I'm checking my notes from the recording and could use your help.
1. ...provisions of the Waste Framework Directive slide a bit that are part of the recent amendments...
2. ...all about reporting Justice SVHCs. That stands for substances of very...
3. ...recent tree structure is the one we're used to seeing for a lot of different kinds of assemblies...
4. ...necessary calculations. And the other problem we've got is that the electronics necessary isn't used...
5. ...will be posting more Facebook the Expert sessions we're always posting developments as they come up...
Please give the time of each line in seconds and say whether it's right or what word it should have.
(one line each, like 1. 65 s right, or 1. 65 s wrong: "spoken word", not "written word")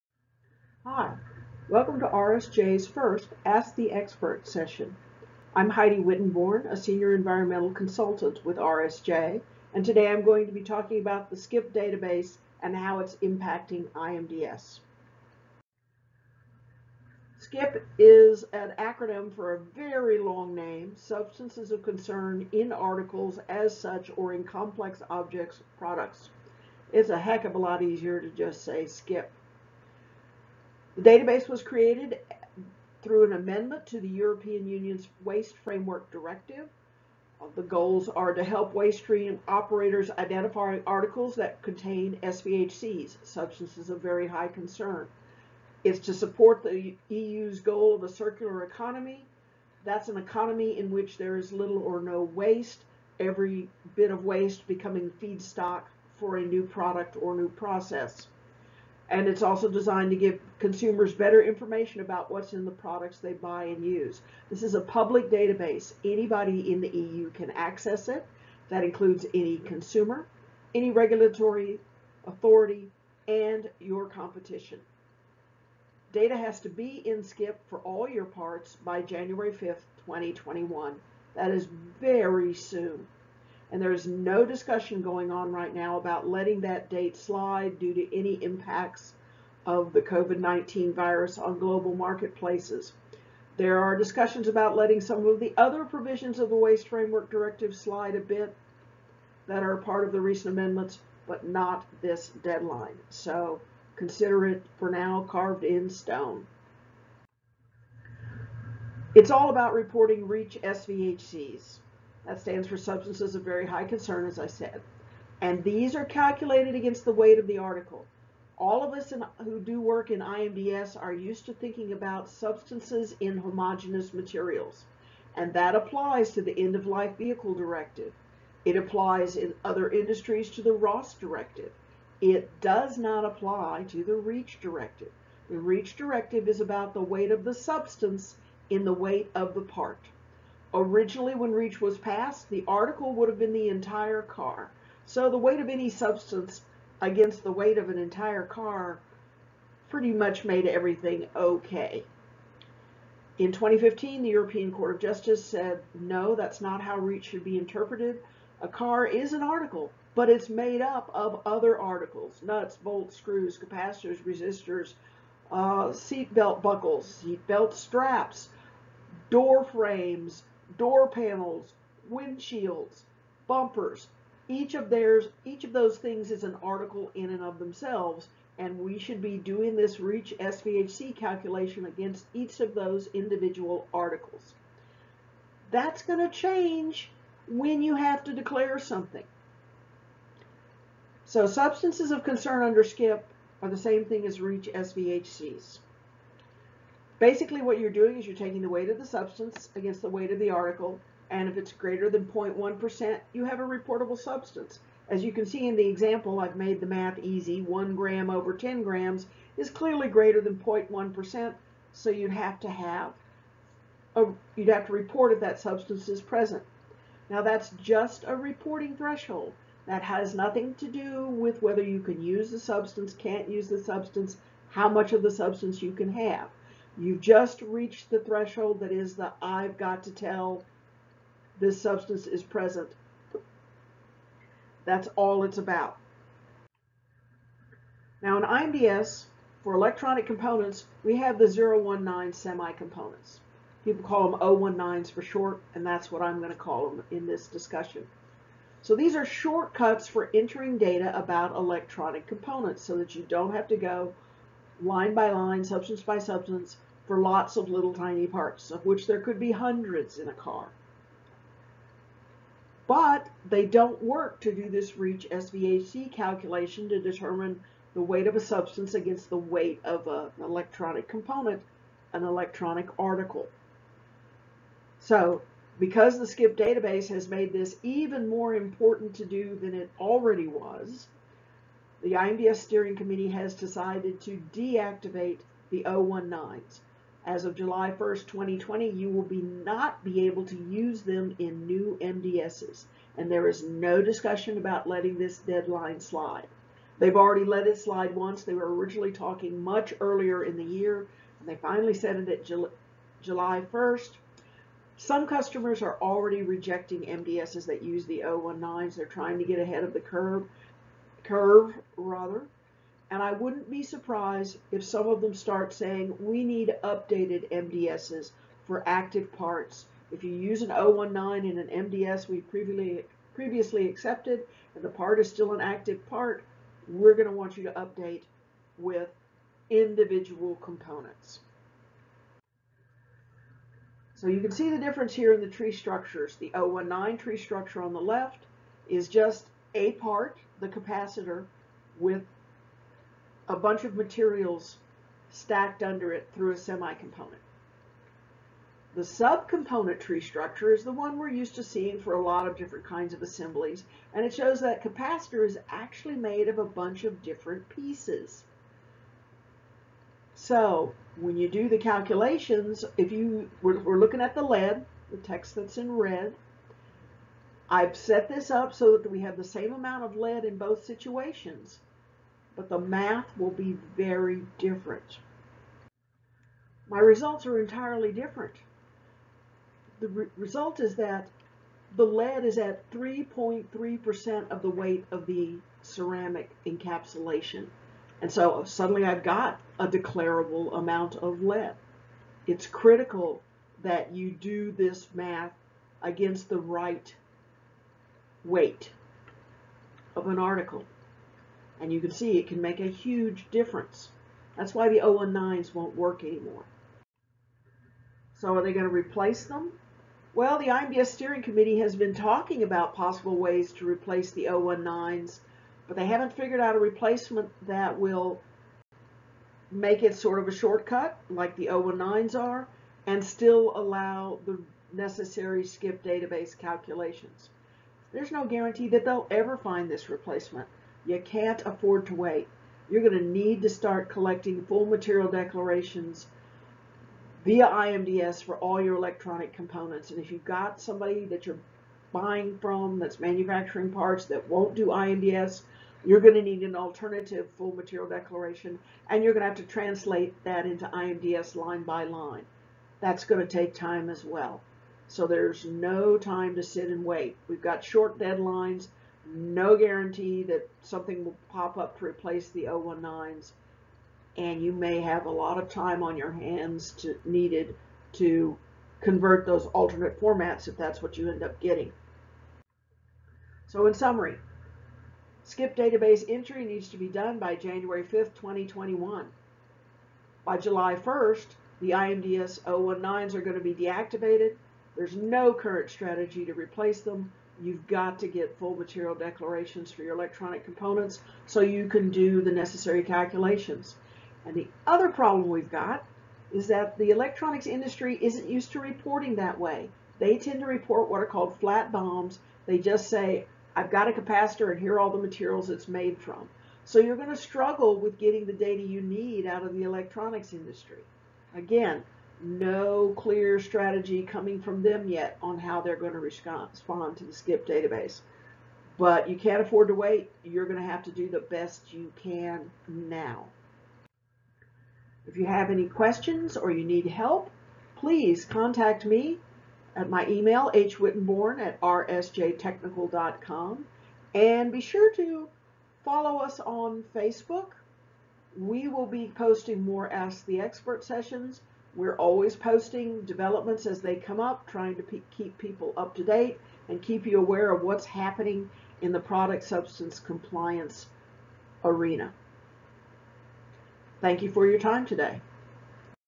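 1. 95 s right
2. 109 s wrong: "REACH", not "Justice"
3. 349 s wrong: "subcomponent", not "recent"
4. 492 s wrong: "industry", not "necessary"
5. 538 s wrong: "Ask", not "Facebook".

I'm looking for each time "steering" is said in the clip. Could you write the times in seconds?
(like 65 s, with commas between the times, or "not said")
282 s, 411 s.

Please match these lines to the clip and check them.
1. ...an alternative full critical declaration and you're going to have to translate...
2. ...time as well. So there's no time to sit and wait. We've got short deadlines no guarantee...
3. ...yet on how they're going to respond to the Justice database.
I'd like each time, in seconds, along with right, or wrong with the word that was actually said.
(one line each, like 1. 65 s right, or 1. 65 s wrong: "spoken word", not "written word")
1. 446 s wrong: "material", not "critical"
2. 453 s right
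3. 515 s wrong: "SCIP", not "Justice".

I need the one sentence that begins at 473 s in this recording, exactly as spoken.
So in summary, SCIP database entry needs to be done by January 5th, 2021.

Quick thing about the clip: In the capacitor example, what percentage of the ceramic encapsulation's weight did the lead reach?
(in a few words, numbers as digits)
3.3%.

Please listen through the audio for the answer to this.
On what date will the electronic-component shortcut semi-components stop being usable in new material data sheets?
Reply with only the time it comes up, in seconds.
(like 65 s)
287 s.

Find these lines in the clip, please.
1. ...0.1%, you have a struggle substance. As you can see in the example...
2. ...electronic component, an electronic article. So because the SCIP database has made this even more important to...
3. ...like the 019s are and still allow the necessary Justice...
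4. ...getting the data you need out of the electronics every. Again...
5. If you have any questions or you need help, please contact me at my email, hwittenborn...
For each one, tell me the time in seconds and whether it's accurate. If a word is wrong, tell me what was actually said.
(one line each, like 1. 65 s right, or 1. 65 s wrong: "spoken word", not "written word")
1. 202 s wrong: "reportable", not "struggle"
2. 270 s right
3. 421 s wrong: "SCIP", not "Justice"
4. 508 s wrong: "industry", not "every"
5. 525 s right.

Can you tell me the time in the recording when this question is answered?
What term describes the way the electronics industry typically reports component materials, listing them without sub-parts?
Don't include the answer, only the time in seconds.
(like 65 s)
501 s.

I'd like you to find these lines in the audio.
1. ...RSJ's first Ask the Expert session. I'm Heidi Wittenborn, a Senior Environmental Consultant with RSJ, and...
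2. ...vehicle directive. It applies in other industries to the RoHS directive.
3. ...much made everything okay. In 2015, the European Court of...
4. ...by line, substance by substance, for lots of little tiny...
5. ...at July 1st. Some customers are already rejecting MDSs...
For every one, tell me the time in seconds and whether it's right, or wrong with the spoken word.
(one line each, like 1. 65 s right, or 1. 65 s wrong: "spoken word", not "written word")
1. 2 s right
2. 127 s right
3. 150 s right
4. 255 s right
5. 302 s right.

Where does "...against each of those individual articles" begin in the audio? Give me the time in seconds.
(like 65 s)
181 s.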